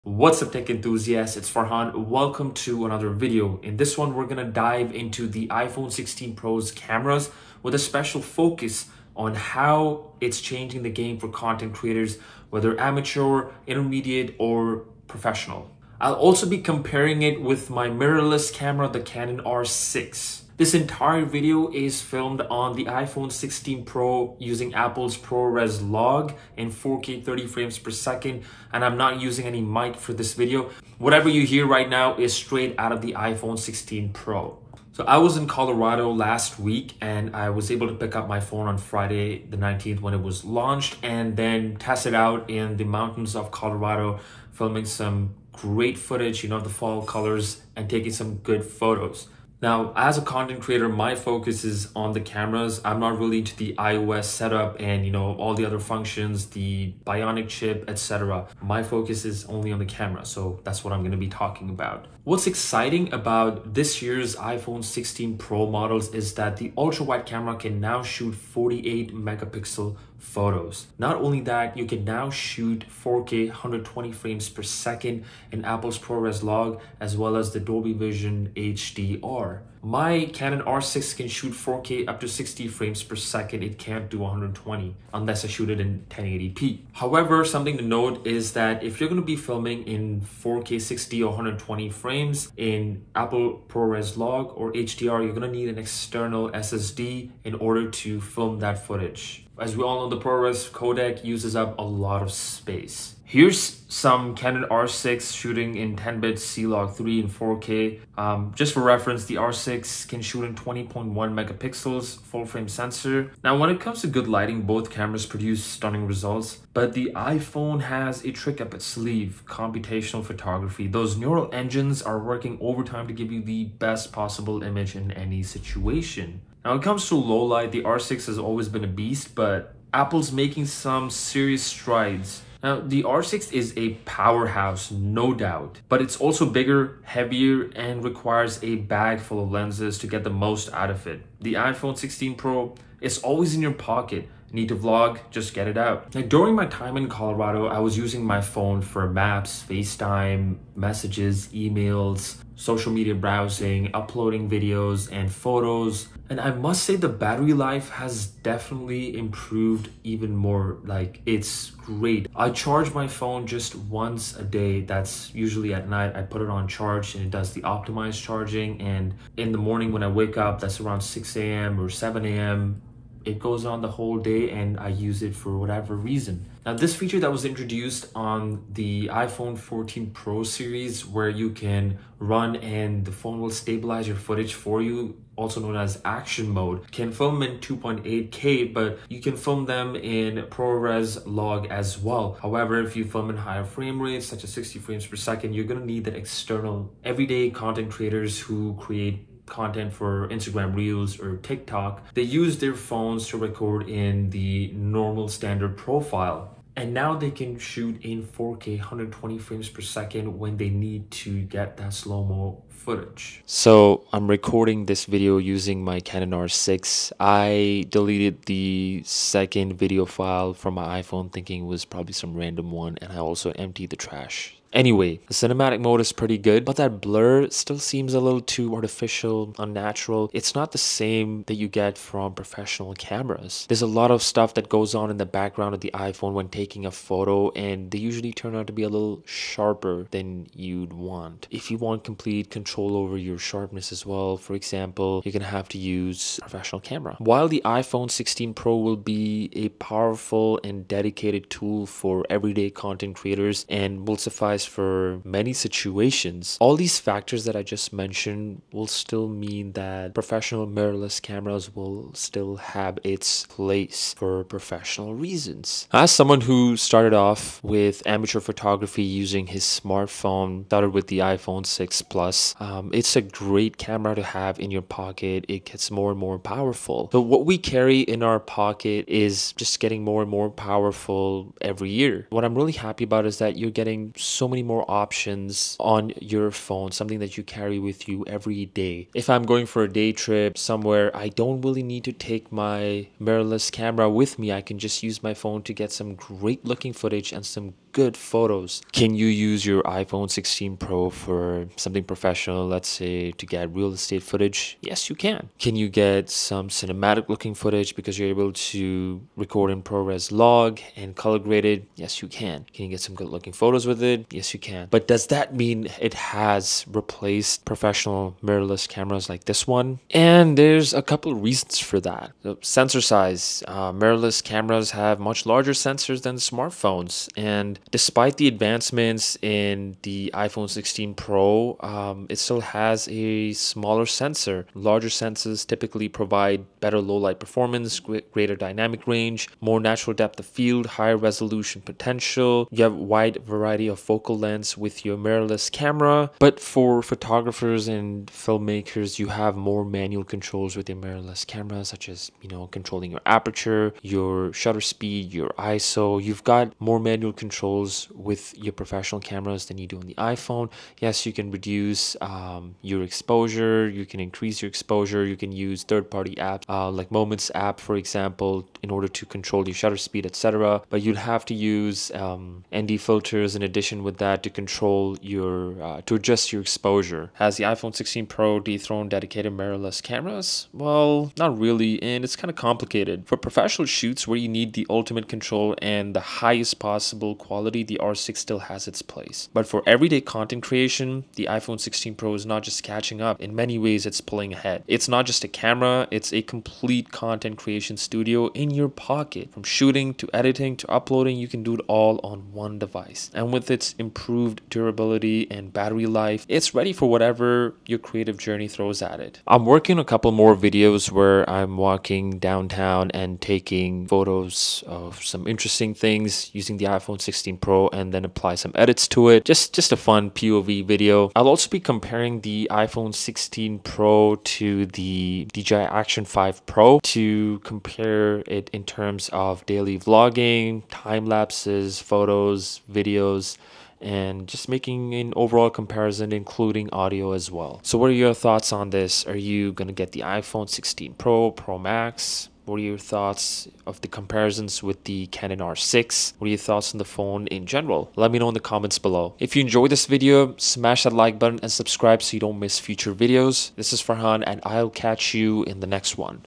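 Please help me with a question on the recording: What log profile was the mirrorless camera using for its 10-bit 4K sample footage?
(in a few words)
C-Log3.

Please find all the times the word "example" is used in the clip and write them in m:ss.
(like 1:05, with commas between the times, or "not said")
4:04, 6:07.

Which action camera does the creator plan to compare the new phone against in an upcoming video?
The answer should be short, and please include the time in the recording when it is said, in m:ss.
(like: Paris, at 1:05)
DJI Action 5 Pro, at 7:05.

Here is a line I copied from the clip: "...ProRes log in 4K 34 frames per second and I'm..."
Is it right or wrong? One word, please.
wrong.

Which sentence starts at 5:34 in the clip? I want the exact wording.
Larger sensors typically provide better low light performance, greater dynamic range, more natural depth of field, higher resolution potential.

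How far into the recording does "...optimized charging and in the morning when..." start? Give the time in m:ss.
2:47.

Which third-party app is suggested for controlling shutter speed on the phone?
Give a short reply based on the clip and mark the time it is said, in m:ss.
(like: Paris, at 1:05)
Moments, at 6:07.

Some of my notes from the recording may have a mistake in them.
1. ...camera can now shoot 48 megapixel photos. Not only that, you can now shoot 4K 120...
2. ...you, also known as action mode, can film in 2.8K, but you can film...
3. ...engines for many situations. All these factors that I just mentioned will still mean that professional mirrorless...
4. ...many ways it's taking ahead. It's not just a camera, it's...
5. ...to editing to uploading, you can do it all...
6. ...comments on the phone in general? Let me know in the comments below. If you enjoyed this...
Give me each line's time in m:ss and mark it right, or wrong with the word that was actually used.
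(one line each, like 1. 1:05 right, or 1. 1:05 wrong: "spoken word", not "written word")
1. 1:07 right
2. 3:04 right
3. 4:14 wrong: "applies", not "engines"
4. 6:33 wrong: "pulling", not "taking"
5. 6:40 right
6. 7:26 wrong: "thoughts", not "comments".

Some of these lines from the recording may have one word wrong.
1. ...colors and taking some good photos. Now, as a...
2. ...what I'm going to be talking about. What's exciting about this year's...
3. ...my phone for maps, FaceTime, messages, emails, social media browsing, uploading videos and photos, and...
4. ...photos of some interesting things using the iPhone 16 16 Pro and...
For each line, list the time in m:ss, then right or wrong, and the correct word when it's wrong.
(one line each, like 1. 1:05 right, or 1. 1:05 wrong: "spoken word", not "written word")
1. 0:47 right
2. 1:00 right
3. 2:28 right
4. 6:54 right.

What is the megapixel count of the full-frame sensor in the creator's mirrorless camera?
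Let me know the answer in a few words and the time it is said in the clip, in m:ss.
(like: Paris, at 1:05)
20.1, at 1:50.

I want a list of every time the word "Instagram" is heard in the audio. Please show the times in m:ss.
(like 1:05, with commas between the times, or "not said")
3:20.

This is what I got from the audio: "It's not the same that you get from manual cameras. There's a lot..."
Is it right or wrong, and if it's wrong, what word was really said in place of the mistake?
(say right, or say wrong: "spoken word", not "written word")
wrong: "professional", not "manual".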